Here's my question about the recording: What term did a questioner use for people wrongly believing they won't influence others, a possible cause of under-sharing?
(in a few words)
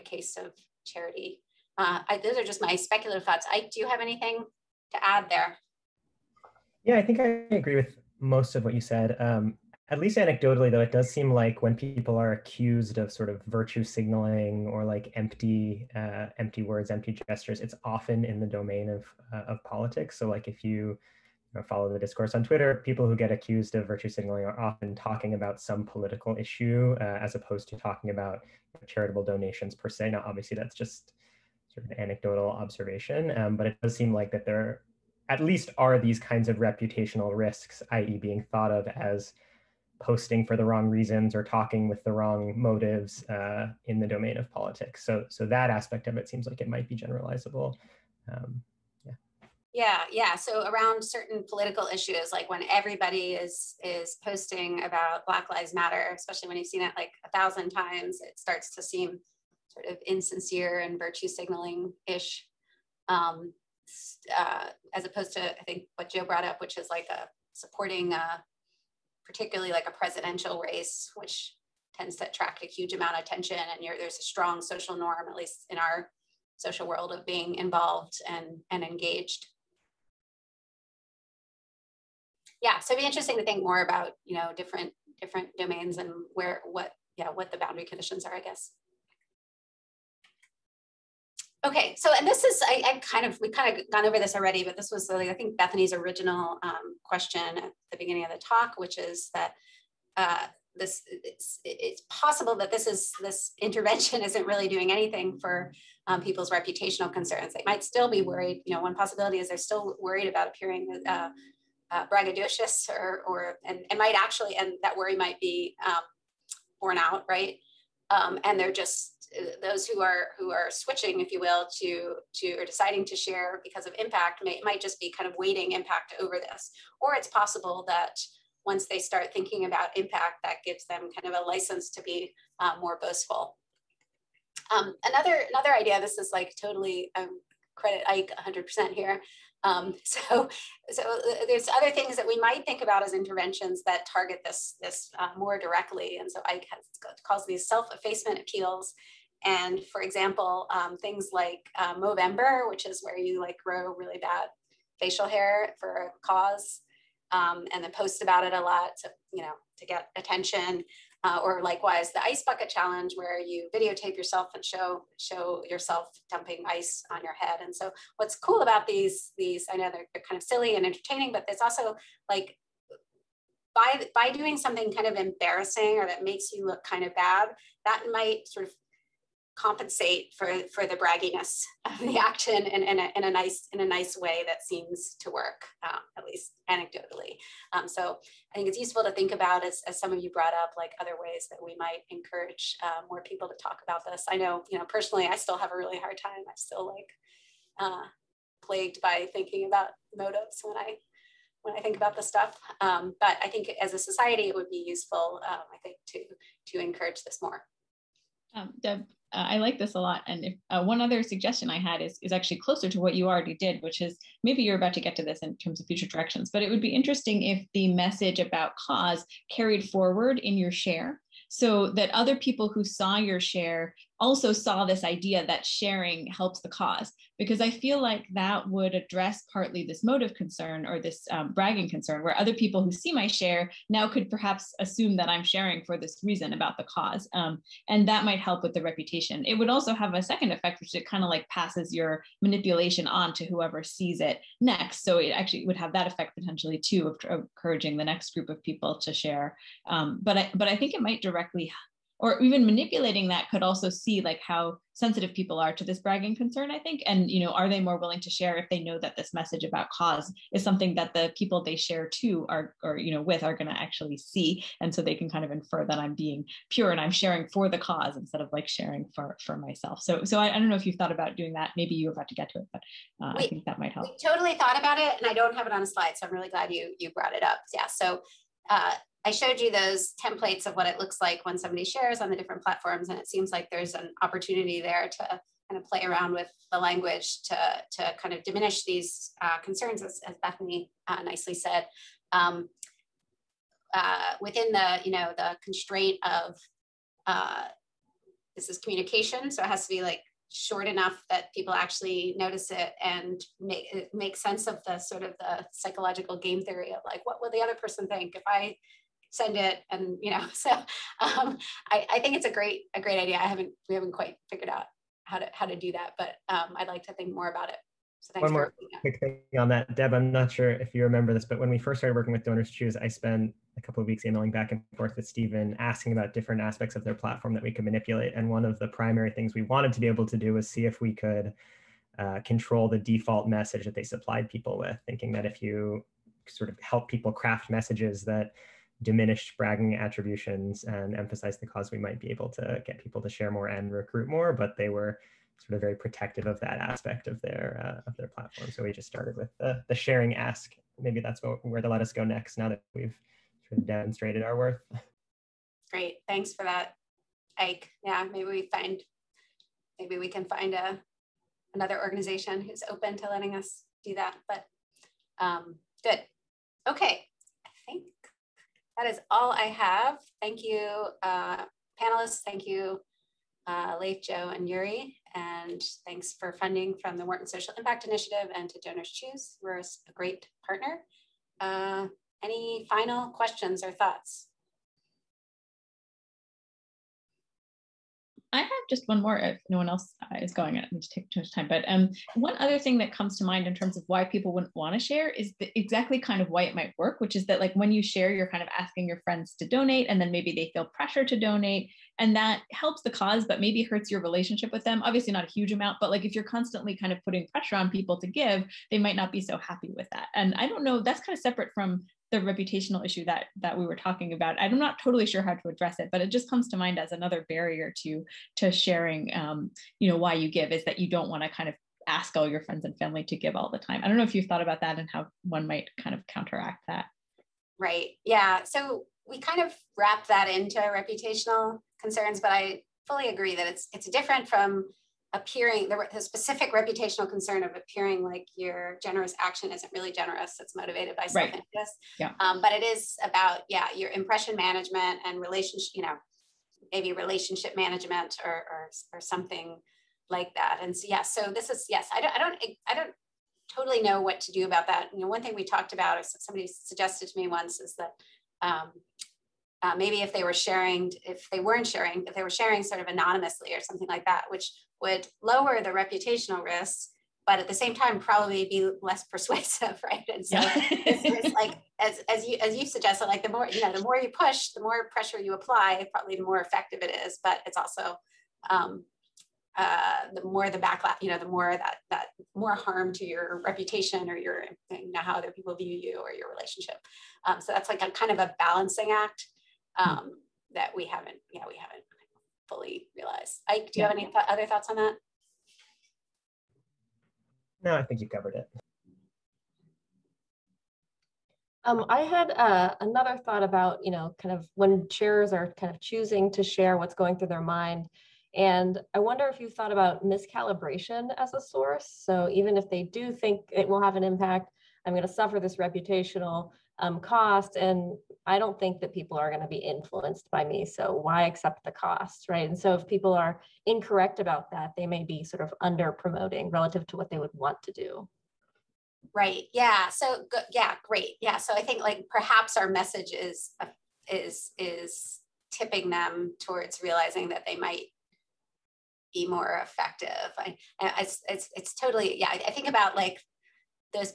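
miscalibration.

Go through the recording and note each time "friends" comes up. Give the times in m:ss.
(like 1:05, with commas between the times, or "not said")
6:39, 7:02.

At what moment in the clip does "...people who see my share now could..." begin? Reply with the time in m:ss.
3:52.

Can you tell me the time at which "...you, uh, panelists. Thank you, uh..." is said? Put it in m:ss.
6:10.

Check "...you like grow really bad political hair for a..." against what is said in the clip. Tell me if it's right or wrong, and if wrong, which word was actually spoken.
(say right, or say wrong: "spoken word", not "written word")
wrong: "facial", not "political".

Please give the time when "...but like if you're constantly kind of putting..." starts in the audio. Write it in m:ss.
6:45.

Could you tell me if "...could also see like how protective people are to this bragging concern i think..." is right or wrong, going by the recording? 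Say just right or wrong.
wrong.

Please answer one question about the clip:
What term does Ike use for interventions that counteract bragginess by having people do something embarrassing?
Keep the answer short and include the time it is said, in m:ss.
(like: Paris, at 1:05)
self-effacement appeals, at 2:27.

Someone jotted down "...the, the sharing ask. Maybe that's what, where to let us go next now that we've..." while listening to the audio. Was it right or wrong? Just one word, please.
right.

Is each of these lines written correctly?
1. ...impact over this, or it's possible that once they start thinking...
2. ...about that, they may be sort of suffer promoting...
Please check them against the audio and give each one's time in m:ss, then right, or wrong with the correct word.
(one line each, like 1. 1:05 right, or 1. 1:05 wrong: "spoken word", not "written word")
1. 2:05 right
2. 8:44 wrong: "under", not "suffer".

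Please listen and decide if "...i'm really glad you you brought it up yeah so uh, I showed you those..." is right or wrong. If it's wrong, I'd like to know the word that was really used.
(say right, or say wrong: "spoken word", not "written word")
right.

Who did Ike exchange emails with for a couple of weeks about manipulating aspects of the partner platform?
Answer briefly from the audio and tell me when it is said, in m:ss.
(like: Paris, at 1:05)
Stephen, at 5:25.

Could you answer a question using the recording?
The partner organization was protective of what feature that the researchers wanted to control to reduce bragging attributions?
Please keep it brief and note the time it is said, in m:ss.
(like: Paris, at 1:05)
the default message, at 5:32.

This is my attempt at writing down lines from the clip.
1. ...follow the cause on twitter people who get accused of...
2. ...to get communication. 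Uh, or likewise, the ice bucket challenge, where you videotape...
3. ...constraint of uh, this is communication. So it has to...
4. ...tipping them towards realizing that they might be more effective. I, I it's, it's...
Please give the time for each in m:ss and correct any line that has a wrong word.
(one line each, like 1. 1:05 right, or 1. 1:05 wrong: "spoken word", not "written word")
1. 0:21 wrong: "discourse", not "cause"
2. 2:39 wrong: "attention", not "communication"
3. 4:55 right
4. 8:55 right.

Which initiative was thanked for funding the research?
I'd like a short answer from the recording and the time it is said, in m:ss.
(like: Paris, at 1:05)
Wharton Social Impact Initiative, at 6:17.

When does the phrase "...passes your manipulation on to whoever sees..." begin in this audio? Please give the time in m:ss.
4:01.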